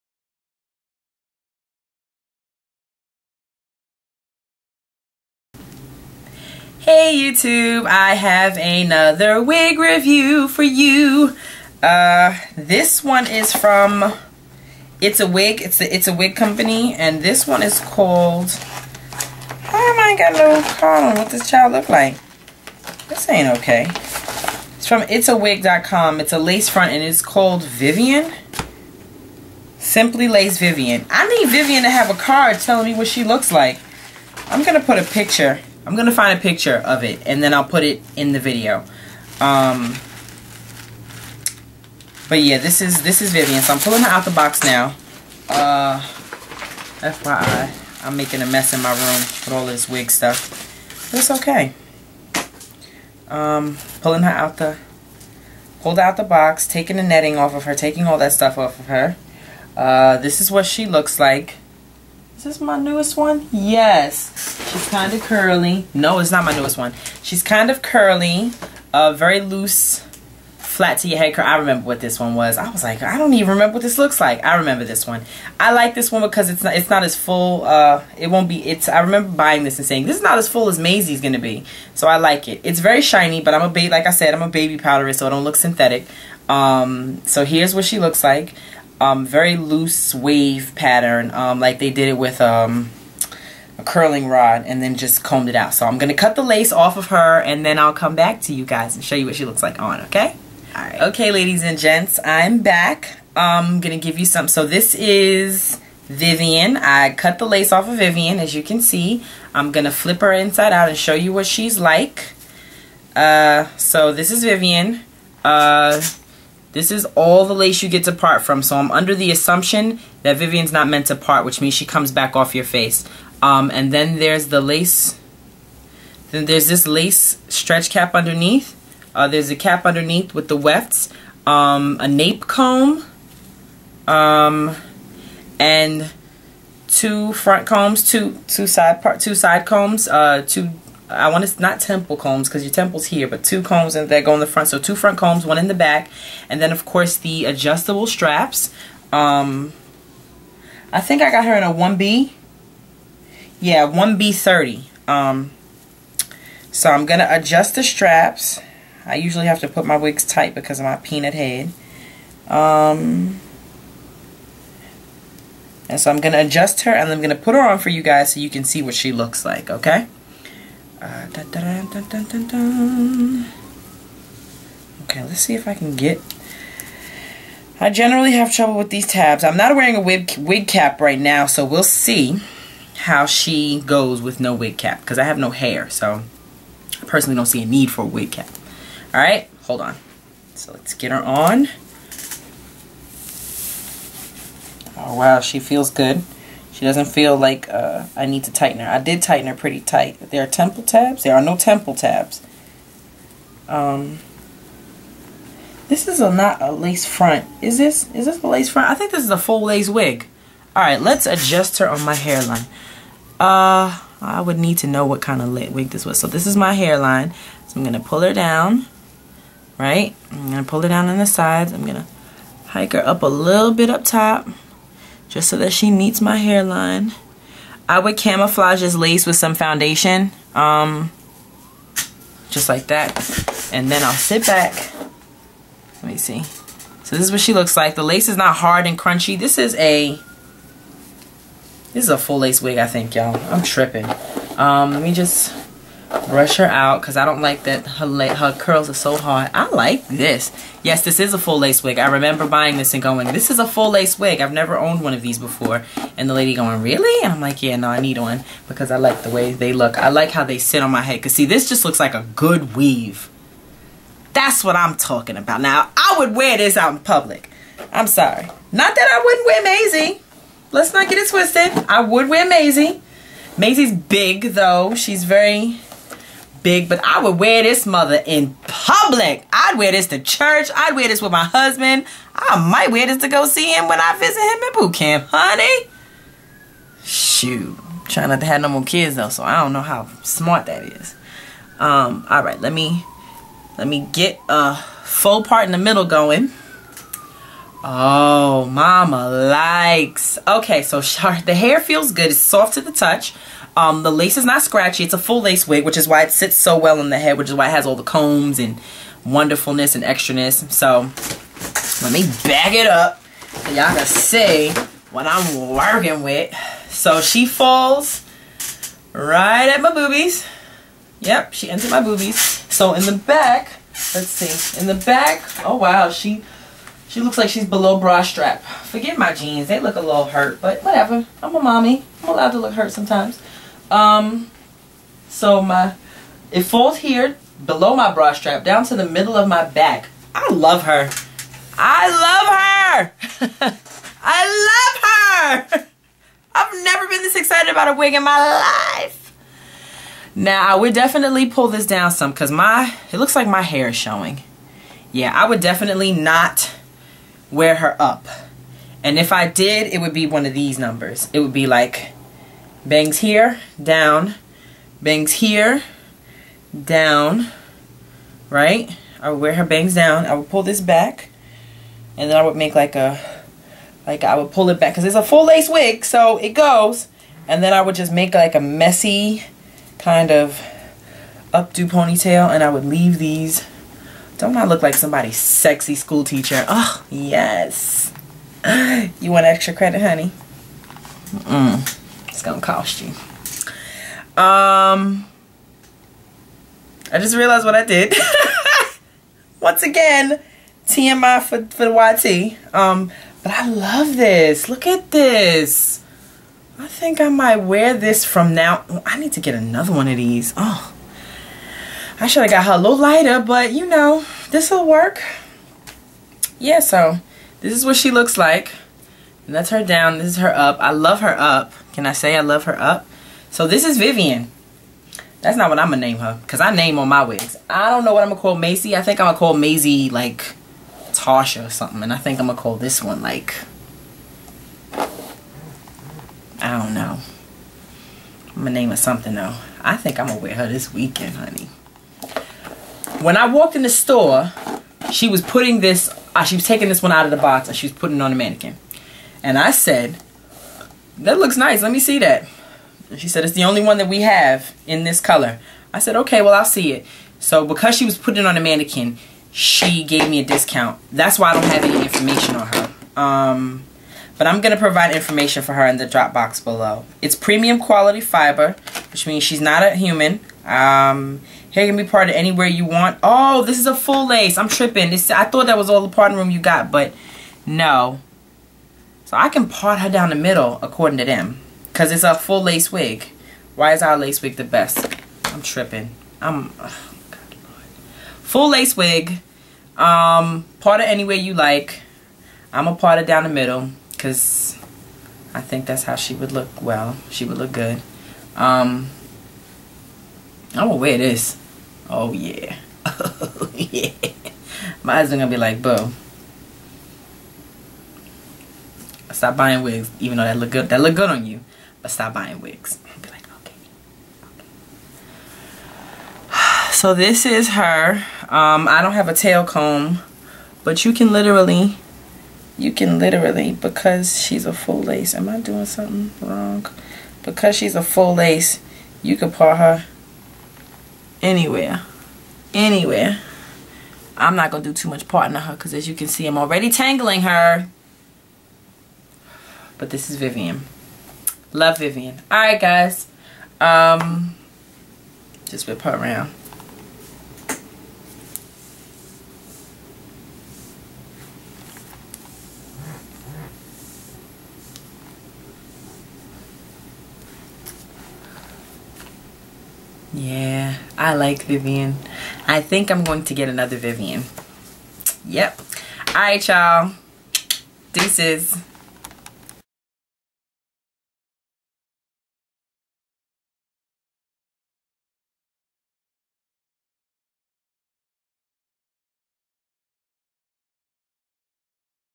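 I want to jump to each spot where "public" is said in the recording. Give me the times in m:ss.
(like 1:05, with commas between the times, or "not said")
4:26, 4:38.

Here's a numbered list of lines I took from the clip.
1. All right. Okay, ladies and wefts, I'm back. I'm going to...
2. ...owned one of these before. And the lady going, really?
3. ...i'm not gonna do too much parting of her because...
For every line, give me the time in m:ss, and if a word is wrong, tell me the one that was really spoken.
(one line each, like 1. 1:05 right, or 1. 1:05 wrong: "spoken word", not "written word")
1. 1:40 wrong: "gents", not "wefts"
2. 4:14 right
3. 8:54 right.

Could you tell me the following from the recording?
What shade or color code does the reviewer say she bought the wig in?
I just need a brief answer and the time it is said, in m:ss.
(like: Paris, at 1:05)
1B30, at 2:33.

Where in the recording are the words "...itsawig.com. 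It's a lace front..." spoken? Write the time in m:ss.
0:25.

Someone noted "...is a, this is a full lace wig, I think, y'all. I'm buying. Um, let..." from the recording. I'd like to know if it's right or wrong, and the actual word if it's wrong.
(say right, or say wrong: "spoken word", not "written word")
wrong: "tripping", not "buying".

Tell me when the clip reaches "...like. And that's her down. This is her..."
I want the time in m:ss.
6:58.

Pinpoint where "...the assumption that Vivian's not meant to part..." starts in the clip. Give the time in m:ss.
1:59.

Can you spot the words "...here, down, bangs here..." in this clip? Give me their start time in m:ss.
6:03.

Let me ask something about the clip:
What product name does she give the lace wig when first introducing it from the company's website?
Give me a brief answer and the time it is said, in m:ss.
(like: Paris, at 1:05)
Simply Lace Vivian, at 0:29.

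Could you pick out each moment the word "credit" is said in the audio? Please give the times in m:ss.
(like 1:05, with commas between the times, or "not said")
6:29.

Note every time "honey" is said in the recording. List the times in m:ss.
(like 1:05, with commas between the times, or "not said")
4:45, 6:30, 7:21.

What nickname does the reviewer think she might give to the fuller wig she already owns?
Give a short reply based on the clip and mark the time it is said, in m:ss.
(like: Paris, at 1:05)
Tasha, at 7:11.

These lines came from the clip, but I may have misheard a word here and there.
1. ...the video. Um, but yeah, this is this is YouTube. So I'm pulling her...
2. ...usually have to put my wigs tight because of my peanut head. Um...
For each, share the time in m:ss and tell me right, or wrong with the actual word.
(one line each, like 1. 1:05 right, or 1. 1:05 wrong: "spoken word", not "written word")
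1. 0:38 wrong: "Vivian", not "YouTube"
2. 2:39 right.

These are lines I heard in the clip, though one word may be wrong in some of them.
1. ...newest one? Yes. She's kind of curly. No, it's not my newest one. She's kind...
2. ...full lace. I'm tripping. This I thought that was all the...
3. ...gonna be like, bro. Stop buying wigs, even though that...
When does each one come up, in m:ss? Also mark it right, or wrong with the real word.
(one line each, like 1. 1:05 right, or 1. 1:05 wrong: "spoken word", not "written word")
1. 1:02 right
2. 7:53 right
3. 8:25 right.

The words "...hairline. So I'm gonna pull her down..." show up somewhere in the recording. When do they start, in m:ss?
3:36.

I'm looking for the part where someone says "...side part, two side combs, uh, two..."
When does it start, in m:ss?
2:18.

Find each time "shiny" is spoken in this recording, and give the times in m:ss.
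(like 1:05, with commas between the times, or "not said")
1:23.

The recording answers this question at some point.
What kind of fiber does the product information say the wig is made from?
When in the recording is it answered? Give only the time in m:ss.
7:47.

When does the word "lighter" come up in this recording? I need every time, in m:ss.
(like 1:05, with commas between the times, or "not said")
6:52.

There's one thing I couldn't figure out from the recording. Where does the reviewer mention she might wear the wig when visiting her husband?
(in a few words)
boot camp.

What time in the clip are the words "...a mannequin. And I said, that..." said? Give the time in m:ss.
7:28.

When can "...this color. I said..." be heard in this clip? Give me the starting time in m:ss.
7:35.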